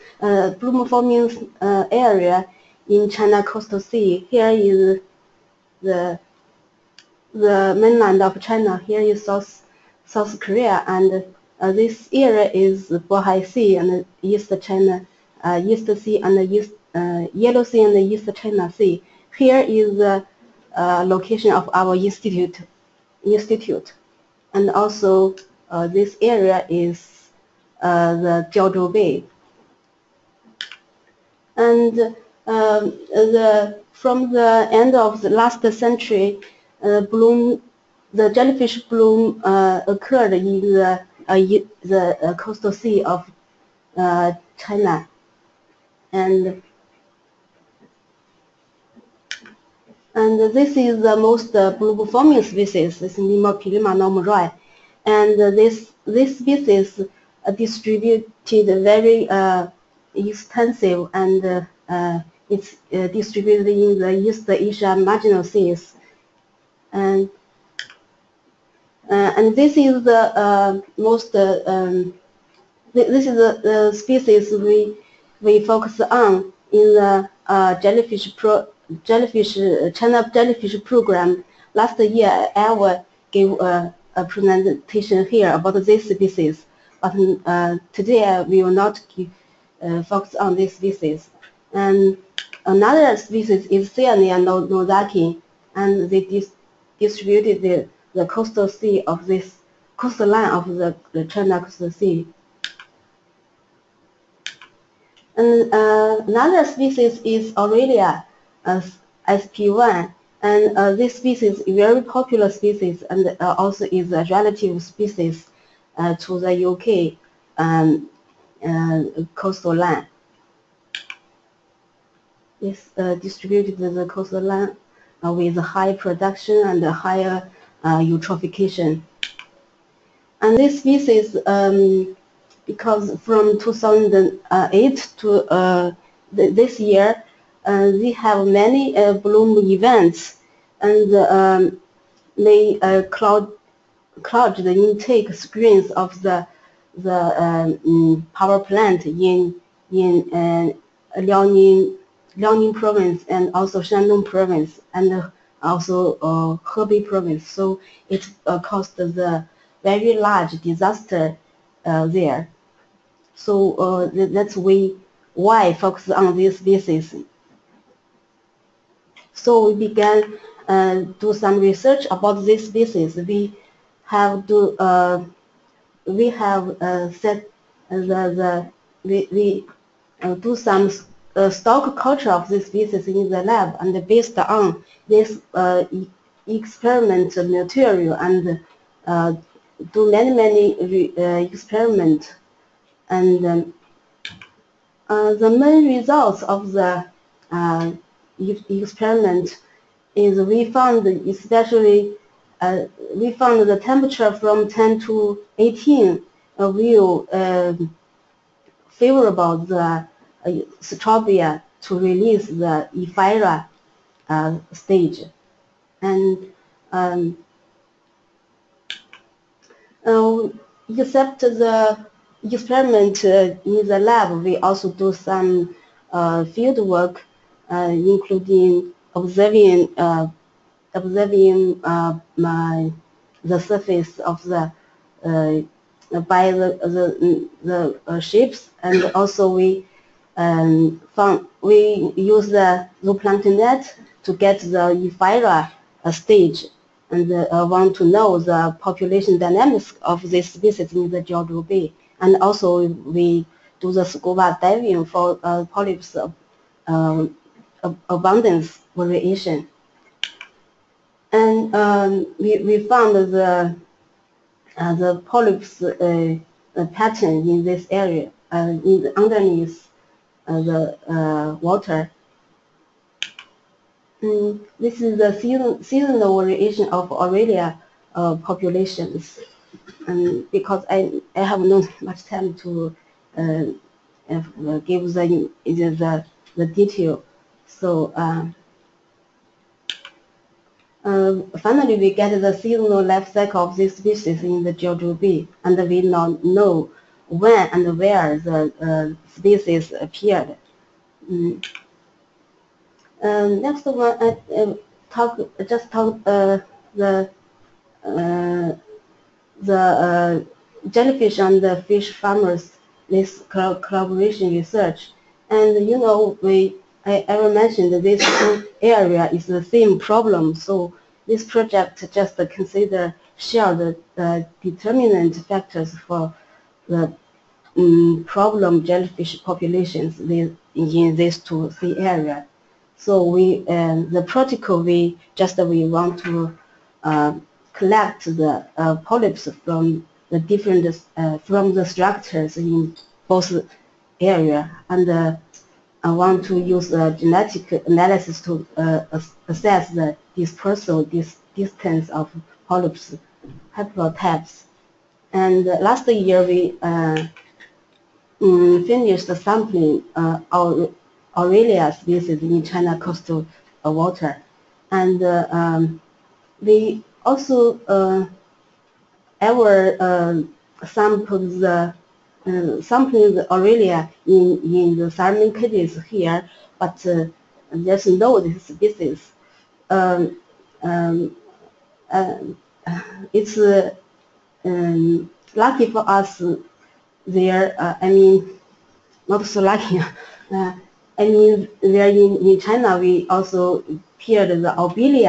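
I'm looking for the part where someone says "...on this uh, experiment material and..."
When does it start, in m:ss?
3:04.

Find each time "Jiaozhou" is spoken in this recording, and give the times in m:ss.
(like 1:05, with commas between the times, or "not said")
0:28, 4:11, 4:54.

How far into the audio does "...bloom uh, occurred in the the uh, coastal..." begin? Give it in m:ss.
0:38.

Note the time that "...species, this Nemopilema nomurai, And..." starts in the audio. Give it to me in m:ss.
0:52.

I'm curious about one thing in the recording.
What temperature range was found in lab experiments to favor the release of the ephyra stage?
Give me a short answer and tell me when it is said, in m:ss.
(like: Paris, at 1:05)
10 to 18, at 3:24.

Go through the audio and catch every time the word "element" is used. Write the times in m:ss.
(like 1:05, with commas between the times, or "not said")
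not said.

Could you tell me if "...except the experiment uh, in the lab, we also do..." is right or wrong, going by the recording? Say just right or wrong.
right.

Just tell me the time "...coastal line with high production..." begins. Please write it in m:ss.
2:04.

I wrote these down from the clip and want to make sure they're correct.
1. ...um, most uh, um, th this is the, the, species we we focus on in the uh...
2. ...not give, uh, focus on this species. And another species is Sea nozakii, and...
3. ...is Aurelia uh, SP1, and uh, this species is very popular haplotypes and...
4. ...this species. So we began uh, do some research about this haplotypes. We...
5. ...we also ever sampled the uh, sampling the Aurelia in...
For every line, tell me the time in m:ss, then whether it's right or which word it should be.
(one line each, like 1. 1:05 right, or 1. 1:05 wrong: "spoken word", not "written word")
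1. 1:10 right
2. 1:28 wrong: "Cyanea", not "Sea"
3. 1:47 wrong: "species", not "haplotypes"
4. 2:46 wrong: "species", not "haplotypes"
5. 6:06 right.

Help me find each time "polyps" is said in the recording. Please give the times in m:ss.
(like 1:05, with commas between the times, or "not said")
4:15, 4:25, 5:38, 5:52.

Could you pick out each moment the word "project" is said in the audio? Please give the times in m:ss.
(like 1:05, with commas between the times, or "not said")
5:21.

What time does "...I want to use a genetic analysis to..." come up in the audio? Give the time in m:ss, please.
5:46.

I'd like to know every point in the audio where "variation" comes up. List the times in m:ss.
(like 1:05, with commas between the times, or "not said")
4:18, 4:36.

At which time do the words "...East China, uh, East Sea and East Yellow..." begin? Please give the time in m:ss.
0:14.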